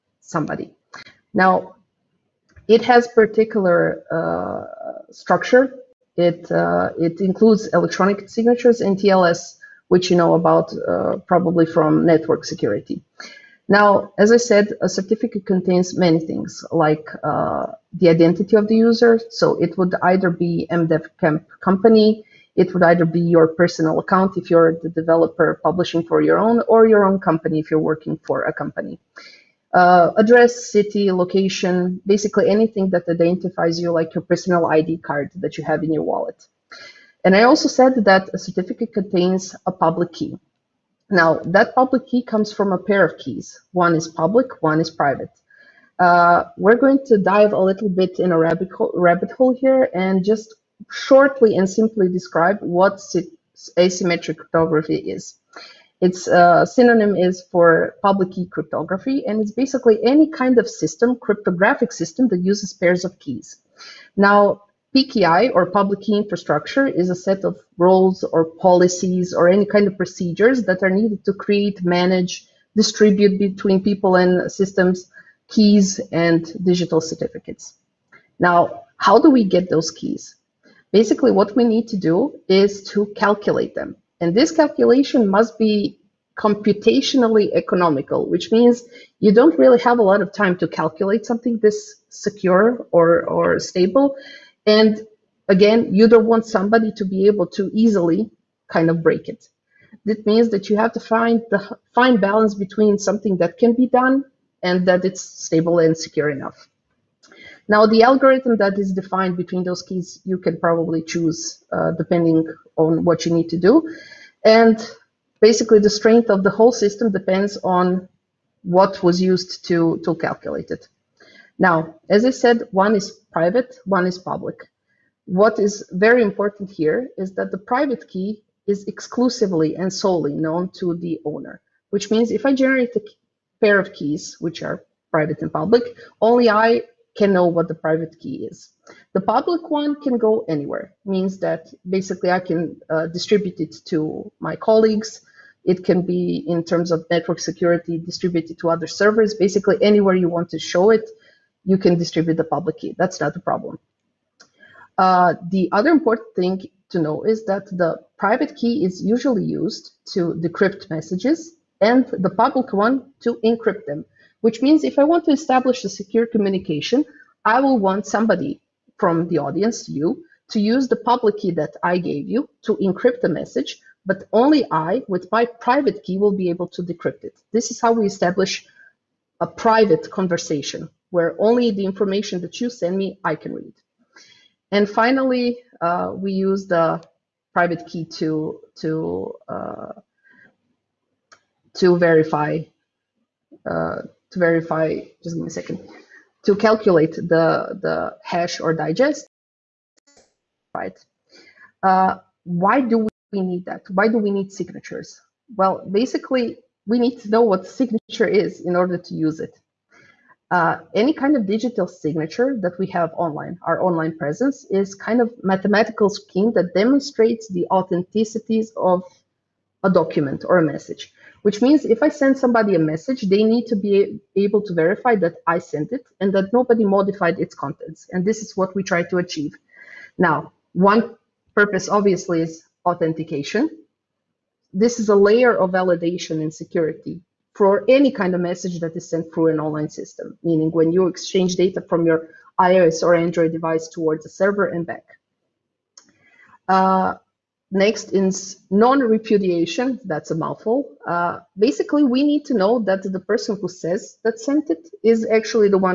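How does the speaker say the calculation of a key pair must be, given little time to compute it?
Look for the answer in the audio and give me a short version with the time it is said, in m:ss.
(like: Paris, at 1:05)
computationally economical, at 1:26.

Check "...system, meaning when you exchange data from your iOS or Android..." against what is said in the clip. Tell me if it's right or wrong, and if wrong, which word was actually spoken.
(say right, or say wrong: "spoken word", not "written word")
right.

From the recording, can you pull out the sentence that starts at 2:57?
This is how we establish a private conversation where only the information that you send me, I can read.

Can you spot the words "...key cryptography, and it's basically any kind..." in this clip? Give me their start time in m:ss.
0:58.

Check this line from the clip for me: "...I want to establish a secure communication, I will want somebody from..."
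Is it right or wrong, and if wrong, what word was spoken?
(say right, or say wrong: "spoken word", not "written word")
right.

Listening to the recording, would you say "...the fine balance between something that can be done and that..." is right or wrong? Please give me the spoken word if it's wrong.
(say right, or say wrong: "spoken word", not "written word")
right.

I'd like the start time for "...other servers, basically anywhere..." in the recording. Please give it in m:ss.
2:28.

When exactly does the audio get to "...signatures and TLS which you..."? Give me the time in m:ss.
0:08.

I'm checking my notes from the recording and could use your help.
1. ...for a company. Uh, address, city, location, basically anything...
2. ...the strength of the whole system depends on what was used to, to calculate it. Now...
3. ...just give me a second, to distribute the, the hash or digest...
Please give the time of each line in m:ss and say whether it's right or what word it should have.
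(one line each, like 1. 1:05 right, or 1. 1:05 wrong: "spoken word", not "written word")
1. 0:28 right
2. 1:55 right
3. 3:15 wrong: "calculate", not "distribute".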